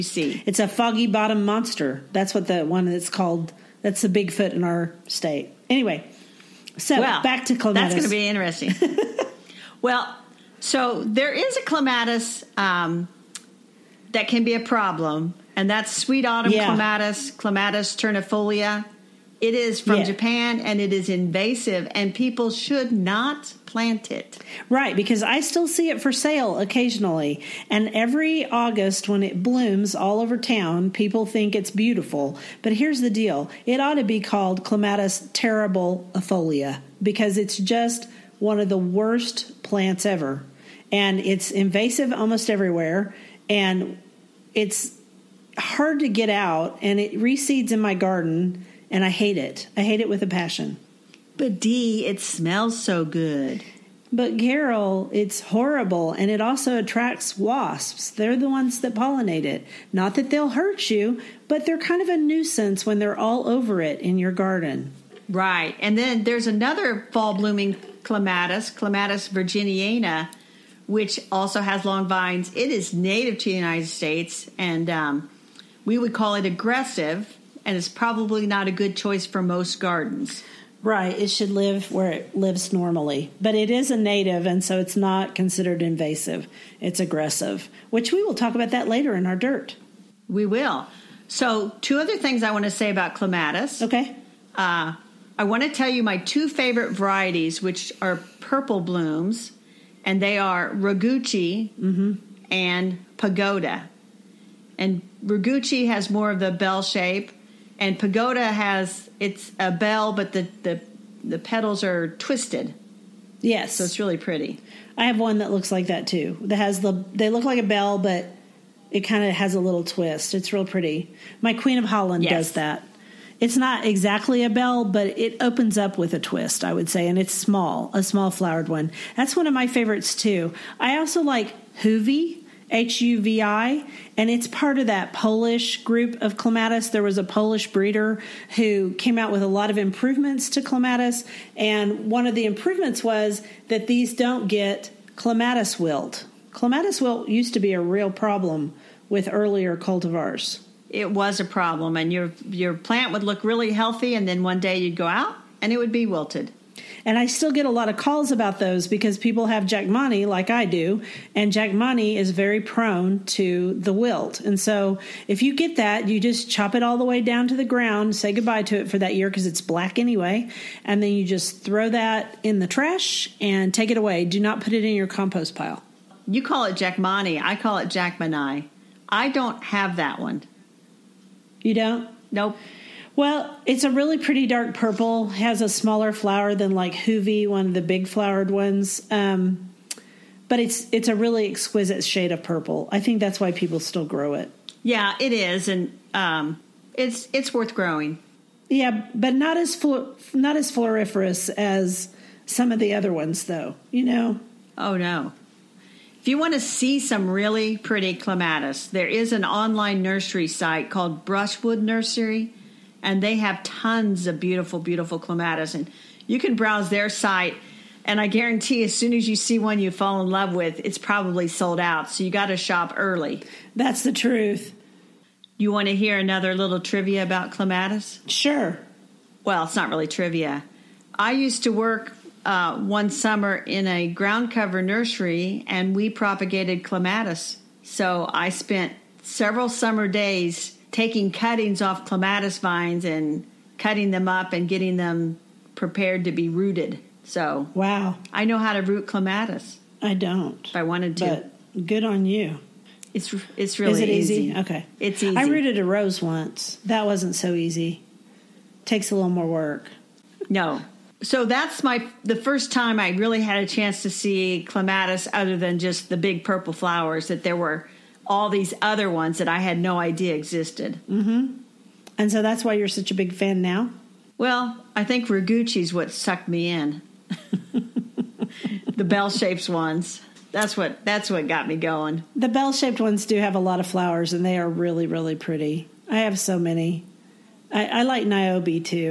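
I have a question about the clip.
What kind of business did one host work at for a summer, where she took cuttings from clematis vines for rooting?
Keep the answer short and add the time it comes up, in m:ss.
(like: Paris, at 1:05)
ground cover nursery, at 3:54.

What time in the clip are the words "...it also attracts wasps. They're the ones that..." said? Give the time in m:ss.
0:56.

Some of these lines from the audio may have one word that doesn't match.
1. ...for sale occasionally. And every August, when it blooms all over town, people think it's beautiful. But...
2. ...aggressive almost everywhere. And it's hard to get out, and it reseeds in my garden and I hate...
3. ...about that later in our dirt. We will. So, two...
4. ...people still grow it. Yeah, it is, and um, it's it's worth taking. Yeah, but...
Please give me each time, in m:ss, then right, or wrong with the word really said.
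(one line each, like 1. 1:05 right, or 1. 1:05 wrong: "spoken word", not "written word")
1. 0:26 right
2. 0:41 wrong: "invasive", not "aggressive"
3. 1:28 right
4. 3:13 wrong: "growing", not "taking".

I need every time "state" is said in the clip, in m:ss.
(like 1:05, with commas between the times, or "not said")
0:05, 1:13.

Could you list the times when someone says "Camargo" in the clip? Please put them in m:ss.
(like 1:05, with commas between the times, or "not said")
not said.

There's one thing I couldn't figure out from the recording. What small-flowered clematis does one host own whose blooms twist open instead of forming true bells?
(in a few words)
Queen of Holland.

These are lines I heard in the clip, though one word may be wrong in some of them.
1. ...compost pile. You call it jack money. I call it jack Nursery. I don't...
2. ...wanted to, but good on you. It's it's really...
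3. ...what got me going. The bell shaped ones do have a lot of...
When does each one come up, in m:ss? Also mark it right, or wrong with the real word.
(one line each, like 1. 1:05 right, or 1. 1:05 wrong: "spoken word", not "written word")
1. 2:55 wrong: "Mani", not "Nursery"
2. 4:10 right
3. 4:41 right.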